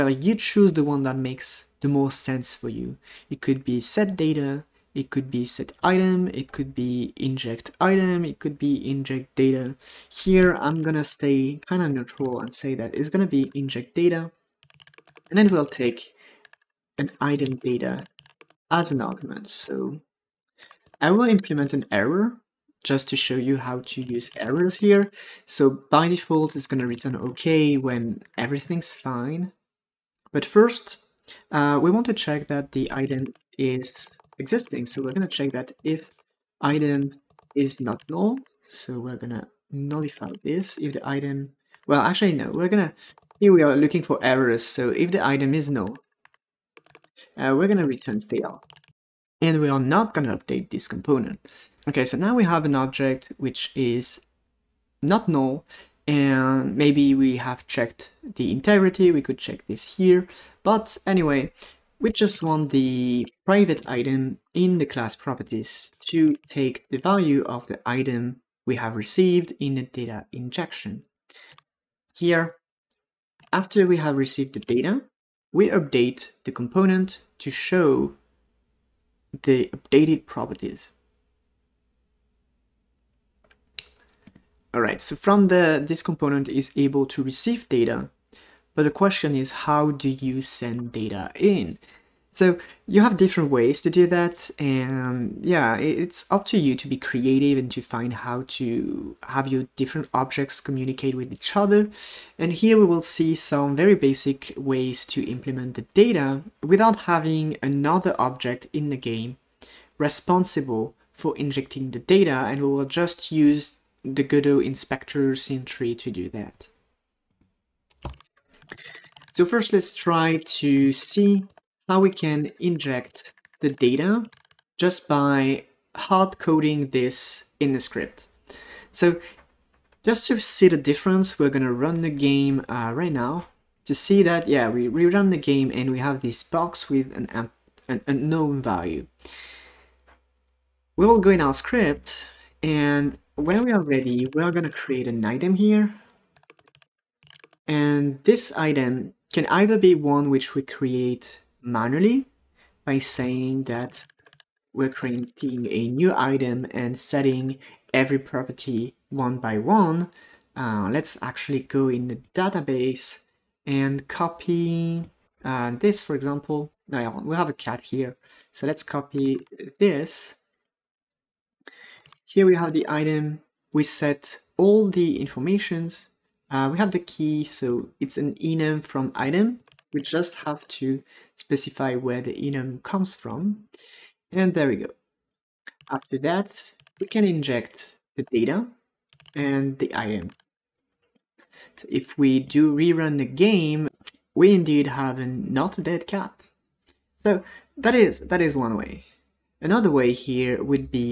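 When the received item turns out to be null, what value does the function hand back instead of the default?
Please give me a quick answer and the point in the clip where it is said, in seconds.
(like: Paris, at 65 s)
fail, at 47 s.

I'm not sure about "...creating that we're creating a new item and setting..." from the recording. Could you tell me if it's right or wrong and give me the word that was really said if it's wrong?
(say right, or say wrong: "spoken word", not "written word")
wrong: "saying", not "creating".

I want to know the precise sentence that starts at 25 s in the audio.
So by default, it's going to return OK when everything's fine.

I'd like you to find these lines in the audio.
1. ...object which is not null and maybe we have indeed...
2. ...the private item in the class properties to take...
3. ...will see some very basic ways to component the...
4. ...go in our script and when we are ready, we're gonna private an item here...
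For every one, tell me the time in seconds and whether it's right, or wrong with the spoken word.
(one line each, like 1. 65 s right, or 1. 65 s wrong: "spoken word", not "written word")
1. 52 s wrong: "checked", not "indeed"
2. 62 s right
3. 102 s wrong: "implement", not "component"
4. 141 s wrong: "create", not "private".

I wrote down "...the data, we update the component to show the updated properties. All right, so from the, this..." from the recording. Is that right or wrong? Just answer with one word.
right.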